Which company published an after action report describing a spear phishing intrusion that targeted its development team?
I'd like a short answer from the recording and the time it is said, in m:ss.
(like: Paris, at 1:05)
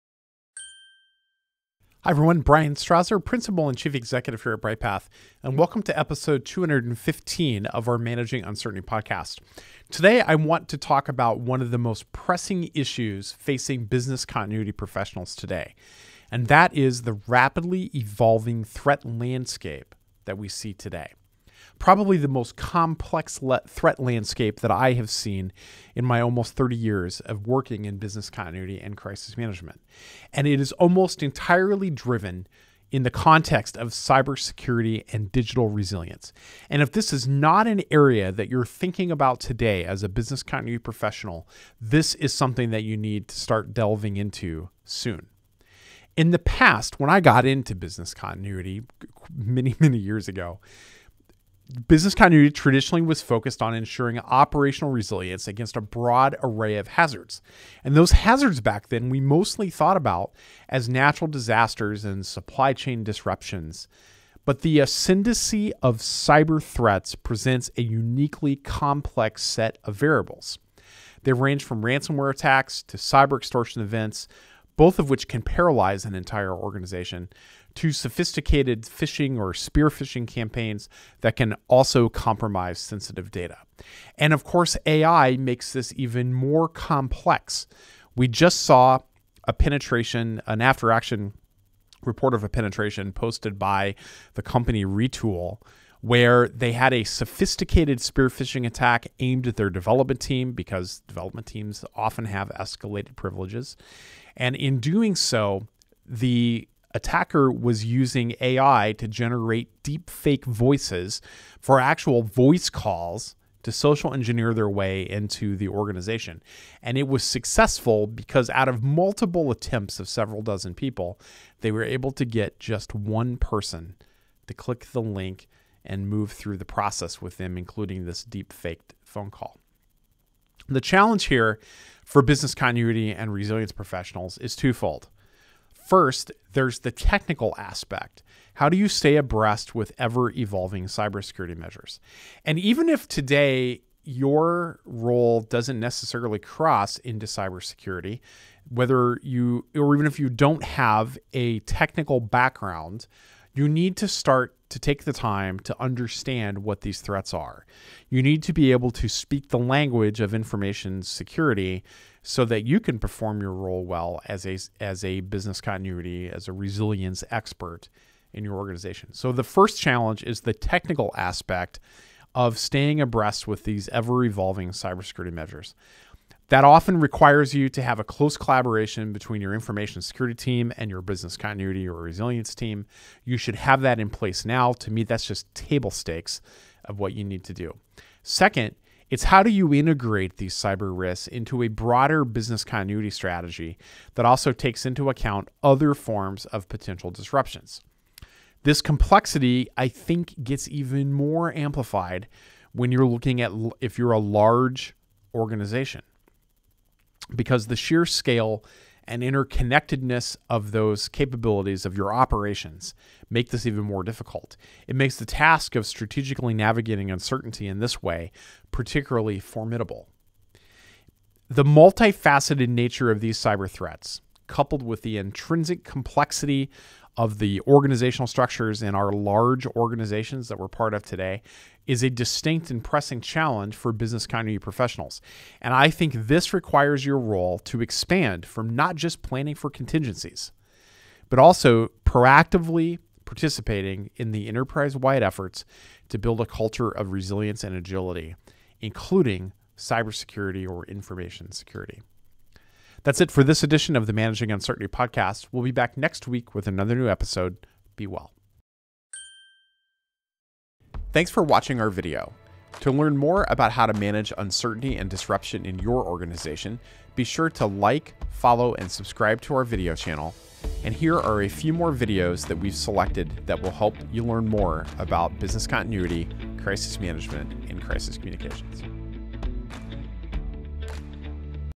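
Retool, at 1:34.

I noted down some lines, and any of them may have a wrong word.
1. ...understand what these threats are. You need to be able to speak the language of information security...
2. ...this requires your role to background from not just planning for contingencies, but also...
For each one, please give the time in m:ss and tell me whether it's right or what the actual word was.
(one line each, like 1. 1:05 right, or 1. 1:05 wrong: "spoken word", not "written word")
1. 2:35 right
2. 3:56 wrong: "expand", not "background".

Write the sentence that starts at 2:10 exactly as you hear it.
The challenge here for business continuity and resilience professionals is twofold.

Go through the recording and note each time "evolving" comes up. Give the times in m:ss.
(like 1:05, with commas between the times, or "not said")
0:17, 2:20, 2:54.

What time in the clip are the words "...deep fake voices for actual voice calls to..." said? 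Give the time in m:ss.
1:49.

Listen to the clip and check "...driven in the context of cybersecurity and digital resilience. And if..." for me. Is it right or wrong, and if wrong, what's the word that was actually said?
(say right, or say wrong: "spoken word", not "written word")
right.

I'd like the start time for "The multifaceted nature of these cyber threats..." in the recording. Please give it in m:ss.
3:41.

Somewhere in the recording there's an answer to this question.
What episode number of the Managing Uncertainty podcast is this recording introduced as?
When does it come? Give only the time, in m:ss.
0:05.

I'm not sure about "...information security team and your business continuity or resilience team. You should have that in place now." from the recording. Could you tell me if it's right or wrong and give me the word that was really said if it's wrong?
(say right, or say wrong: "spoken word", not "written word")
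right.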